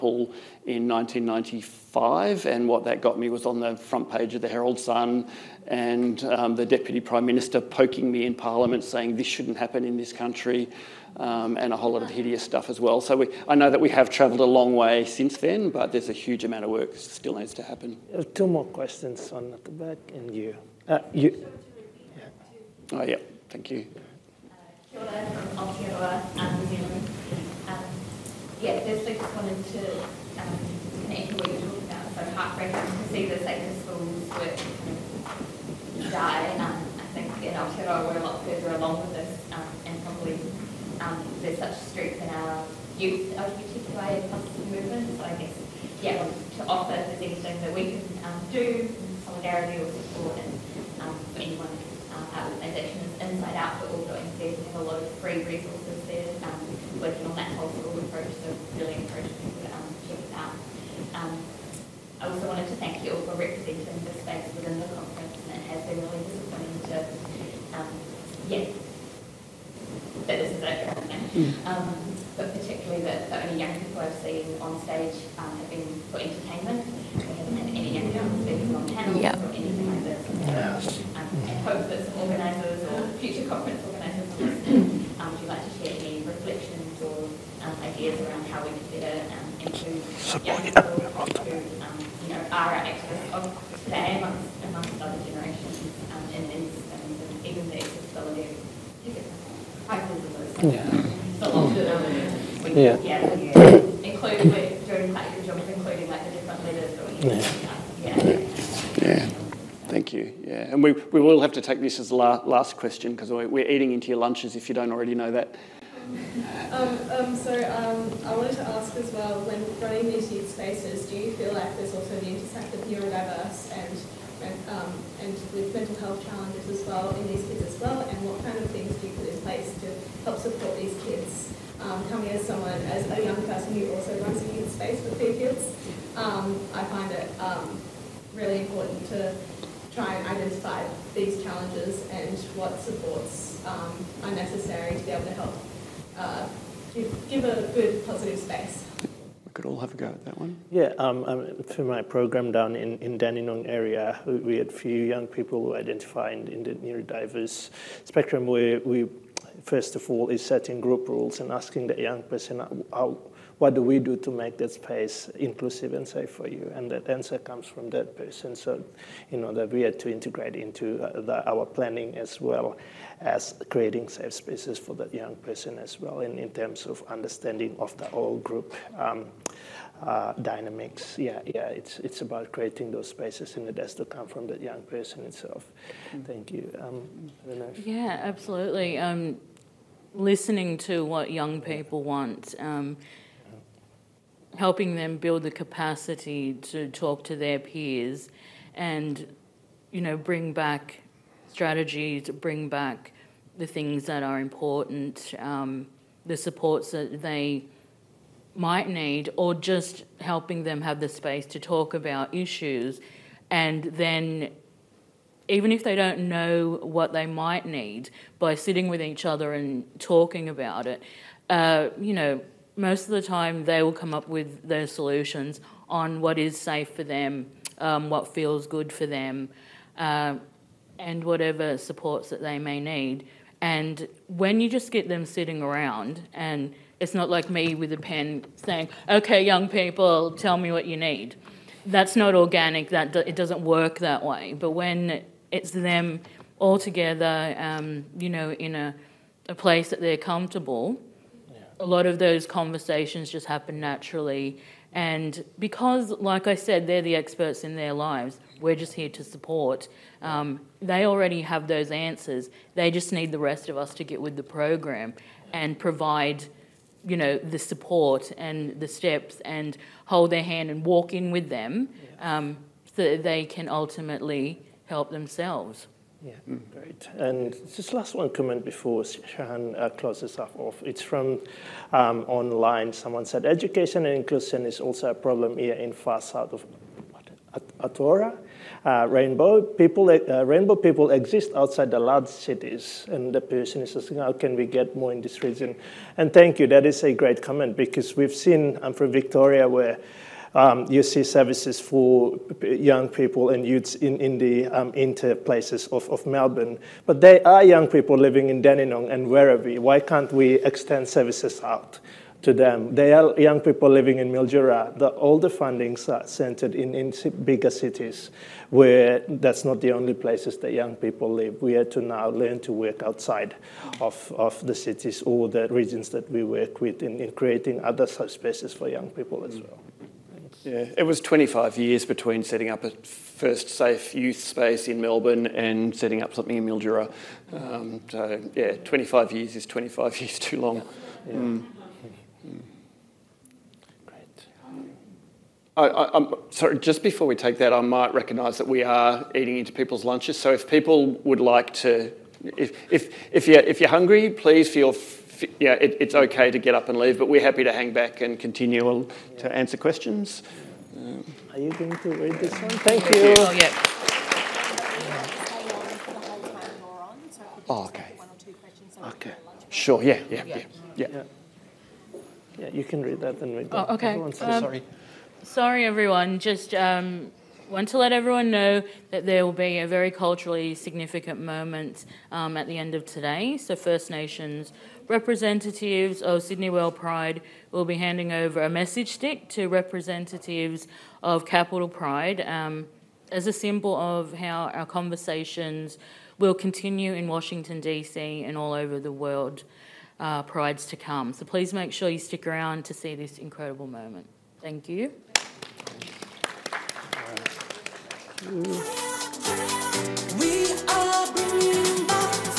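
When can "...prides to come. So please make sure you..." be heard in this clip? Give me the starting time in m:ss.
6:40.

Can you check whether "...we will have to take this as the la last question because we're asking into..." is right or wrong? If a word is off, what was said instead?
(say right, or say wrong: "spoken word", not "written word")
wrong: "eating", not "asking".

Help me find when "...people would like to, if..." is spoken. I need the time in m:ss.
5:50.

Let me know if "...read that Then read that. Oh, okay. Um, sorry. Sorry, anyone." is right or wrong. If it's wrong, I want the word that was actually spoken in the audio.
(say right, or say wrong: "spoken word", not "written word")
wrong: "everyone", not "anyone".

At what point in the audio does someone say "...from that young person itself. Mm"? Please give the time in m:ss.
3:04.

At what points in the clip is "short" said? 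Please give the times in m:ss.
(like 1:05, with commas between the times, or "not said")
not said.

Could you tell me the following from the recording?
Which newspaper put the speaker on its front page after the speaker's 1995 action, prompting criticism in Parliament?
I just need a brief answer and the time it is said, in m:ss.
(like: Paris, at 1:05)
Herald Sun, at 0:04.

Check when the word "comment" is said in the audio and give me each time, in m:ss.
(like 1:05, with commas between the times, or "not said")
4:38, 4:57.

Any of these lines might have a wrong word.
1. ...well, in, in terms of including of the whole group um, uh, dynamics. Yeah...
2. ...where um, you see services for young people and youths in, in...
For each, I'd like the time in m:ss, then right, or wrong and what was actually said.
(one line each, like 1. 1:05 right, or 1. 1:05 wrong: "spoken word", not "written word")
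1. 2:55 wrong: "understanding", not "including"
2. 4:59 right.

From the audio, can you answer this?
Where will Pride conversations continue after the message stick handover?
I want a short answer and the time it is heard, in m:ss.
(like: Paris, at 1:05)
Washington, D.C., at 6:37.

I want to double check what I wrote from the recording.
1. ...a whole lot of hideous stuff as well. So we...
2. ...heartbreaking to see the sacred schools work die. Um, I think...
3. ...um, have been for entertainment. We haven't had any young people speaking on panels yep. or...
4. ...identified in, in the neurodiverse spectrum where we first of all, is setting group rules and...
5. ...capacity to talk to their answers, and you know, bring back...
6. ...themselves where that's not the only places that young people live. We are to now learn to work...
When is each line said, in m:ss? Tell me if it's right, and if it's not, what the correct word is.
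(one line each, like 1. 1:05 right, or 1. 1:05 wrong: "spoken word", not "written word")
1. 0:11 right
2. 0:32 right
3. 1:15 right
4. 2:35 right
5. 3:15 wrong: "peers", not "answers"
6. 5:17 wrong: "cities", not "themselves".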